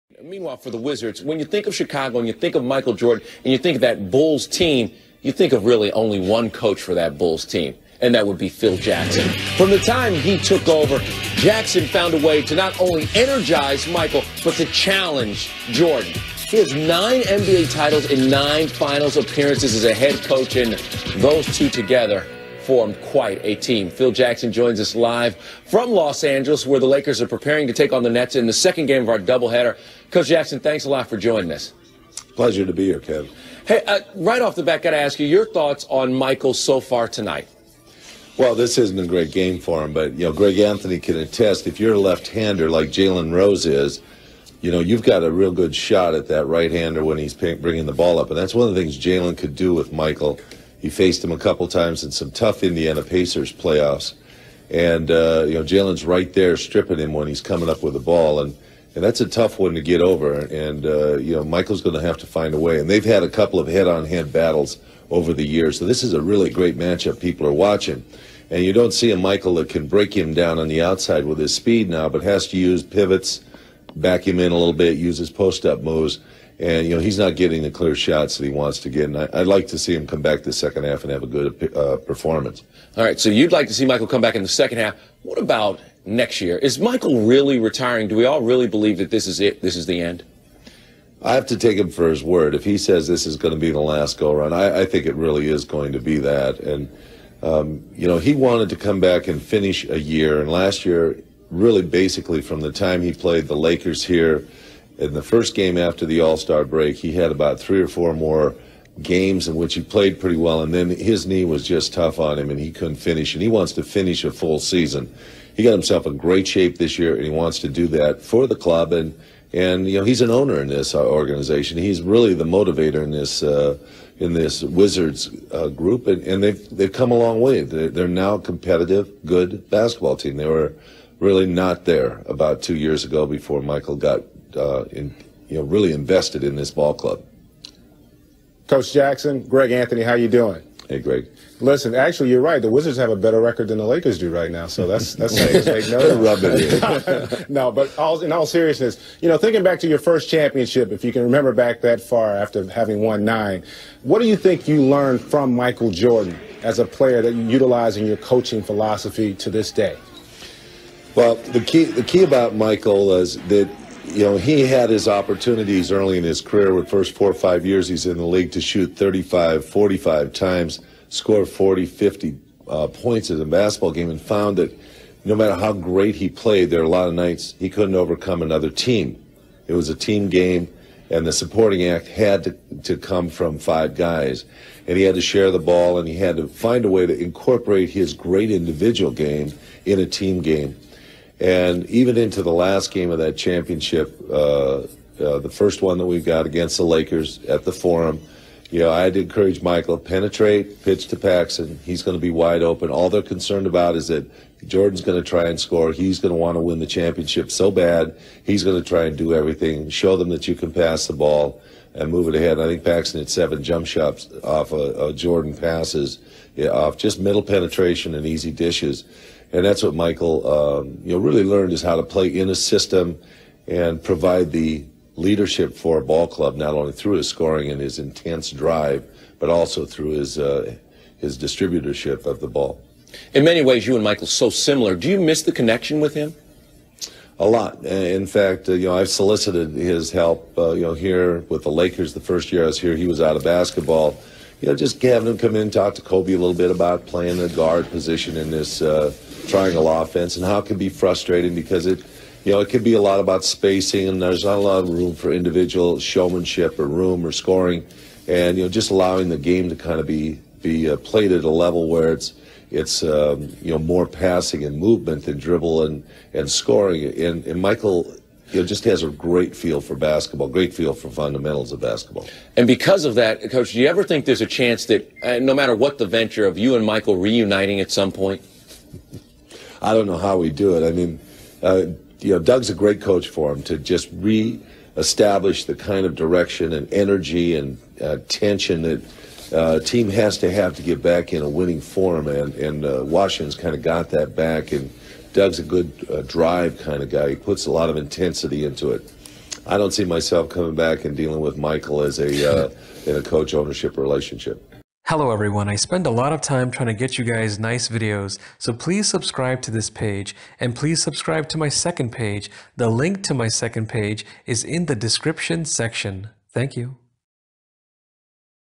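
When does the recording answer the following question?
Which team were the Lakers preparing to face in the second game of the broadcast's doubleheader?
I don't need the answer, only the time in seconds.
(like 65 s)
28 s.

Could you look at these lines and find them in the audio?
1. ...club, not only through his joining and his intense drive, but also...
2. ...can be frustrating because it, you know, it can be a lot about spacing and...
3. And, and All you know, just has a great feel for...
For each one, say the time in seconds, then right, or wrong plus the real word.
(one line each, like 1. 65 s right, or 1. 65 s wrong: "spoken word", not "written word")
1. 226 s wrong: "scoring", not "joining"
2. 250 s right
3. 267 s wrong: "Michael", not "All".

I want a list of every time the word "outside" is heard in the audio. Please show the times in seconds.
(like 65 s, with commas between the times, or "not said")
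70 s.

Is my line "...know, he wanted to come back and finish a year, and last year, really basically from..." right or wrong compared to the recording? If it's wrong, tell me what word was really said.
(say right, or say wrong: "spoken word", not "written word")
right.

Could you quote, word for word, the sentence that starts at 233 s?
In many ways, you and Michael so similar.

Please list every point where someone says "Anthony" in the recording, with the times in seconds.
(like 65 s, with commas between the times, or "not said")
40 s, 139 s.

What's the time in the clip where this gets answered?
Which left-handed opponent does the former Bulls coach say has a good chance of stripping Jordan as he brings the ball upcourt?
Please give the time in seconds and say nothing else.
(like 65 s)
42 s.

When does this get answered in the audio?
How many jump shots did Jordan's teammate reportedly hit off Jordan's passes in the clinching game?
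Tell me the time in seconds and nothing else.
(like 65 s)
213 s.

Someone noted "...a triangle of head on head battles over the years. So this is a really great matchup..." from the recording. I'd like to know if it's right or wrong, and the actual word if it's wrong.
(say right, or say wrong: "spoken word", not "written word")
wrong: "couple", not "triangle".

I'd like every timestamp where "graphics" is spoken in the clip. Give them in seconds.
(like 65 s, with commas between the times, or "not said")
not said.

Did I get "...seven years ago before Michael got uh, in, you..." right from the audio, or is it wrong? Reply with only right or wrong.
wrong.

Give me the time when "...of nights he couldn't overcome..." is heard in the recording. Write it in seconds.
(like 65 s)
177 s.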